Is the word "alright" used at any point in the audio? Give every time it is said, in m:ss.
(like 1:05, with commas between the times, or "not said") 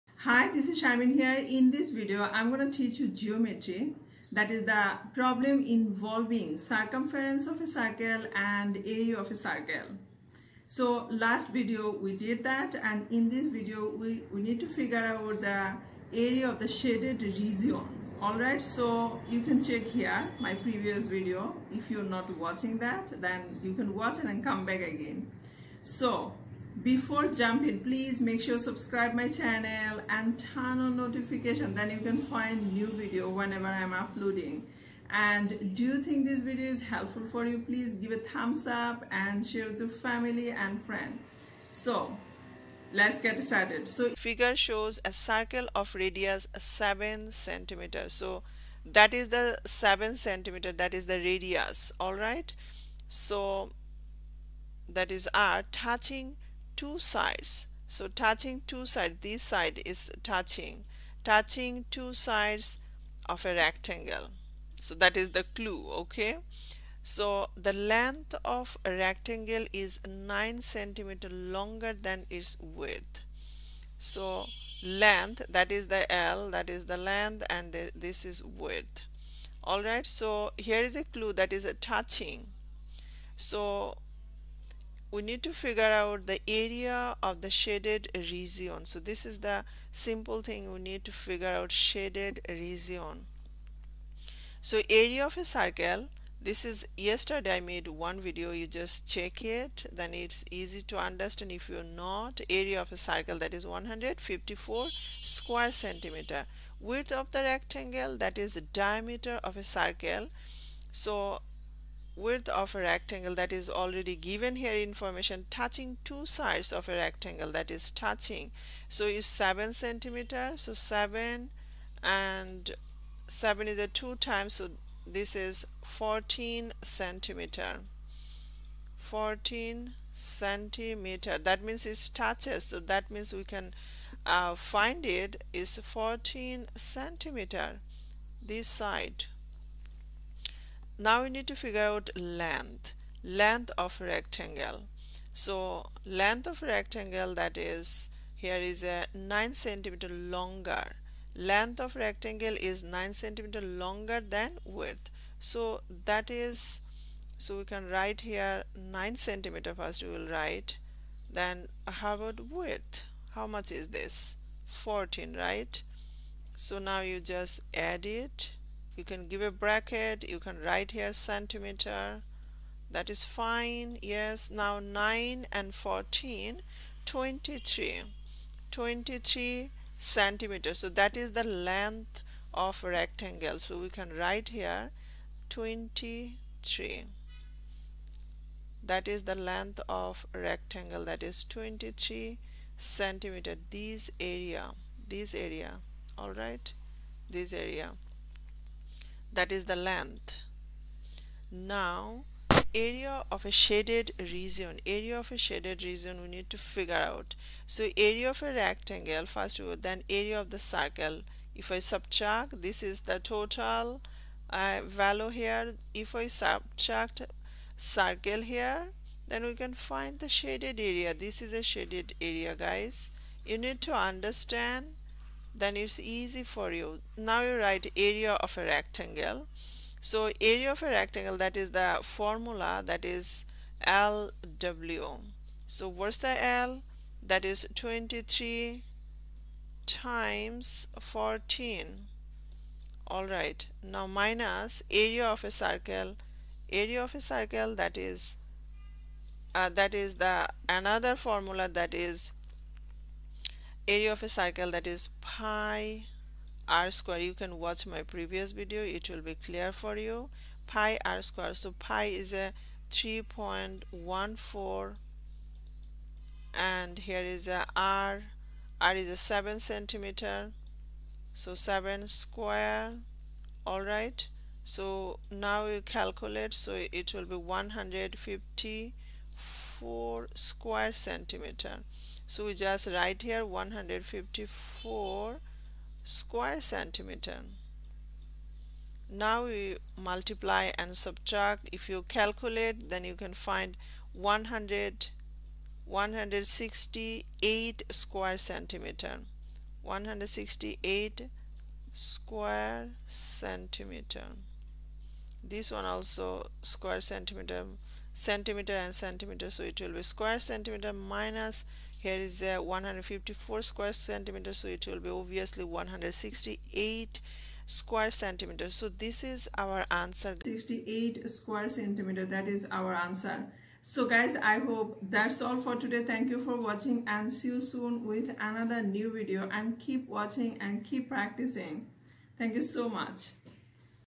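0:18, 1:19.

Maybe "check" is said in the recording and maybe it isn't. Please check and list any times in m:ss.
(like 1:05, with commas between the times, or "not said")
0:19, 1:39.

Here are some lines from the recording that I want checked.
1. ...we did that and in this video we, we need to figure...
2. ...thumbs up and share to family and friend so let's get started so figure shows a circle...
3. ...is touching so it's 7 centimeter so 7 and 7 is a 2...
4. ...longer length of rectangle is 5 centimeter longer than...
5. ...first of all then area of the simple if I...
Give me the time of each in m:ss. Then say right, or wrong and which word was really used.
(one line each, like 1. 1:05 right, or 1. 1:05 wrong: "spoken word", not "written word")
1. 0:11 right
2. 0:38 right
3. 1:57 right
4. 2:30 wrong: "9", not "5"
5. 3:29 wrong: "circle", not "simple".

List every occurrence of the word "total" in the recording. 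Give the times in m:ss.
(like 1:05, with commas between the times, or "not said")
3:33.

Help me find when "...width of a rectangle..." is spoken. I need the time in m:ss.
1:52.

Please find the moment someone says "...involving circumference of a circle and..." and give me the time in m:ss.
0:05.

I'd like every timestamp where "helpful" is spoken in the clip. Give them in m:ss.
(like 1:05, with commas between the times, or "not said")
0:36.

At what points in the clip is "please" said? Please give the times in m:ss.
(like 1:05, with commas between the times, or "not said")
0:27, 0:37.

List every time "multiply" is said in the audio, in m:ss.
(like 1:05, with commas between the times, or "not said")
4:50.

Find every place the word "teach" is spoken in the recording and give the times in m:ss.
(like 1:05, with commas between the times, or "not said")
0:02.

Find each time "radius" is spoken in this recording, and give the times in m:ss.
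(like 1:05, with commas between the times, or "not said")
0:45, 0:51.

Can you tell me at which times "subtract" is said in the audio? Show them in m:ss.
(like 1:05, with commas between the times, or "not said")
3:31, 3:36, 4:50.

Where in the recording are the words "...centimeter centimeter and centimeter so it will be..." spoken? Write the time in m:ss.
5:07.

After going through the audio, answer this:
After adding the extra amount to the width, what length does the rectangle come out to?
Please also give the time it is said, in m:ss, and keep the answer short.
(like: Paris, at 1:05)
23 centimeters, at 2:58.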